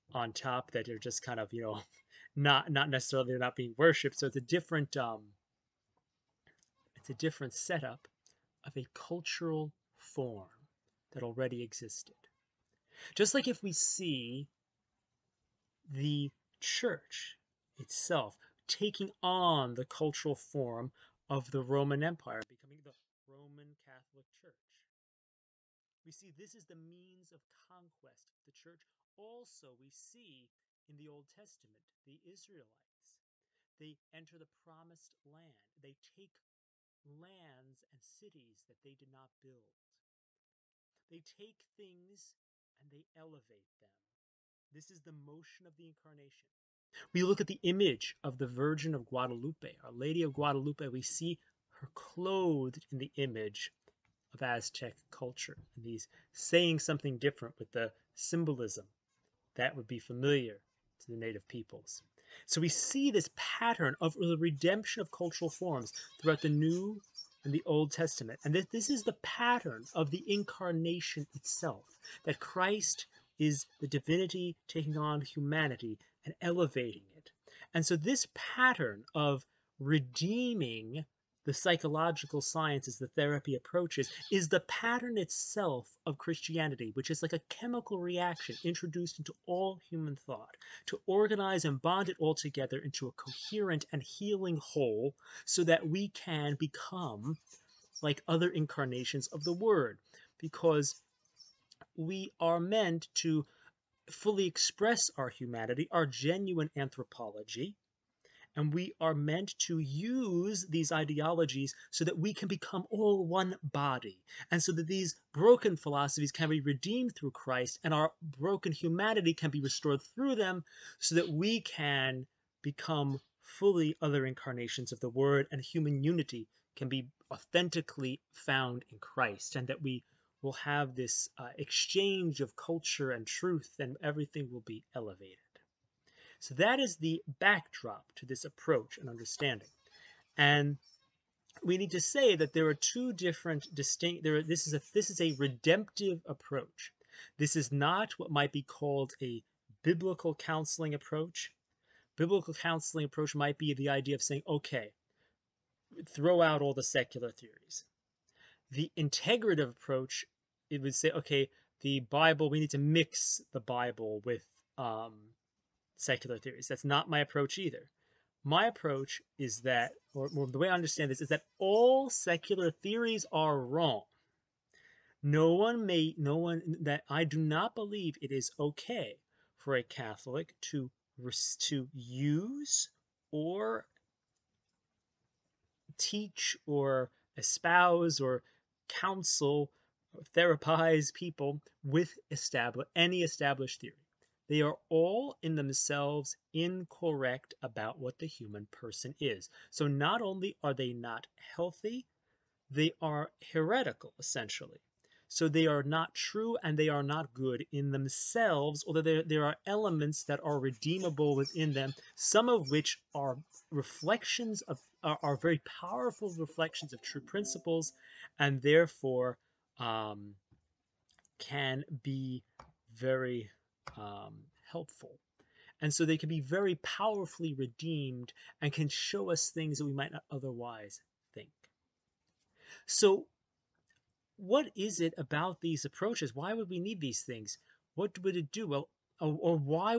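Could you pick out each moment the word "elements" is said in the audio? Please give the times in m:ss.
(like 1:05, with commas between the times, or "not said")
3:29.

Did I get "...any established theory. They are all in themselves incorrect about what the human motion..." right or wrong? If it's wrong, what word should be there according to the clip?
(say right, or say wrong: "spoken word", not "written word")
wrong: "person", not "motion".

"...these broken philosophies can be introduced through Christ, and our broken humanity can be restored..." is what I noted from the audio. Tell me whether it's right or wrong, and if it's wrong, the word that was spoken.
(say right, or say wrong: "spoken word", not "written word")
wrong: "redeemed", not "introduced".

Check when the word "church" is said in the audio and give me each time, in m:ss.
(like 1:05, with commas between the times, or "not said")
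0:16, 0:24, 0:28.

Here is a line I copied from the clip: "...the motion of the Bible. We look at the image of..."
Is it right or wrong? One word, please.
wrong.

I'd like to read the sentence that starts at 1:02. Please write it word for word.
So we see this pattern of the redemption of cultural forms throughout the New and the Old Testament.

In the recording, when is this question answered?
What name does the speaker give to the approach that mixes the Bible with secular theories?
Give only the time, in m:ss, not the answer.
2:38.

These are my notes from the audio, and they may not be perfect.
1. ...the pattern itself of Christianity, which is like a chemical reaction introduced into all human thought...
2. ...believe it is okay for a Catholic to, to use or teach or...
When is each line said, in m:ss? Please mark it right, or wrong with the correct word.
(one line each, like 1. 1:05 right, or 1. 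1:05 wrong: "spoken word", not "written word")
1. 1:24 right
2. 2:57 right.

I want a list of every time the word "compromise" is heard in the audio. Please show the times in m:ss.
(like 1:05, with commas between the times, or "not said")
not said.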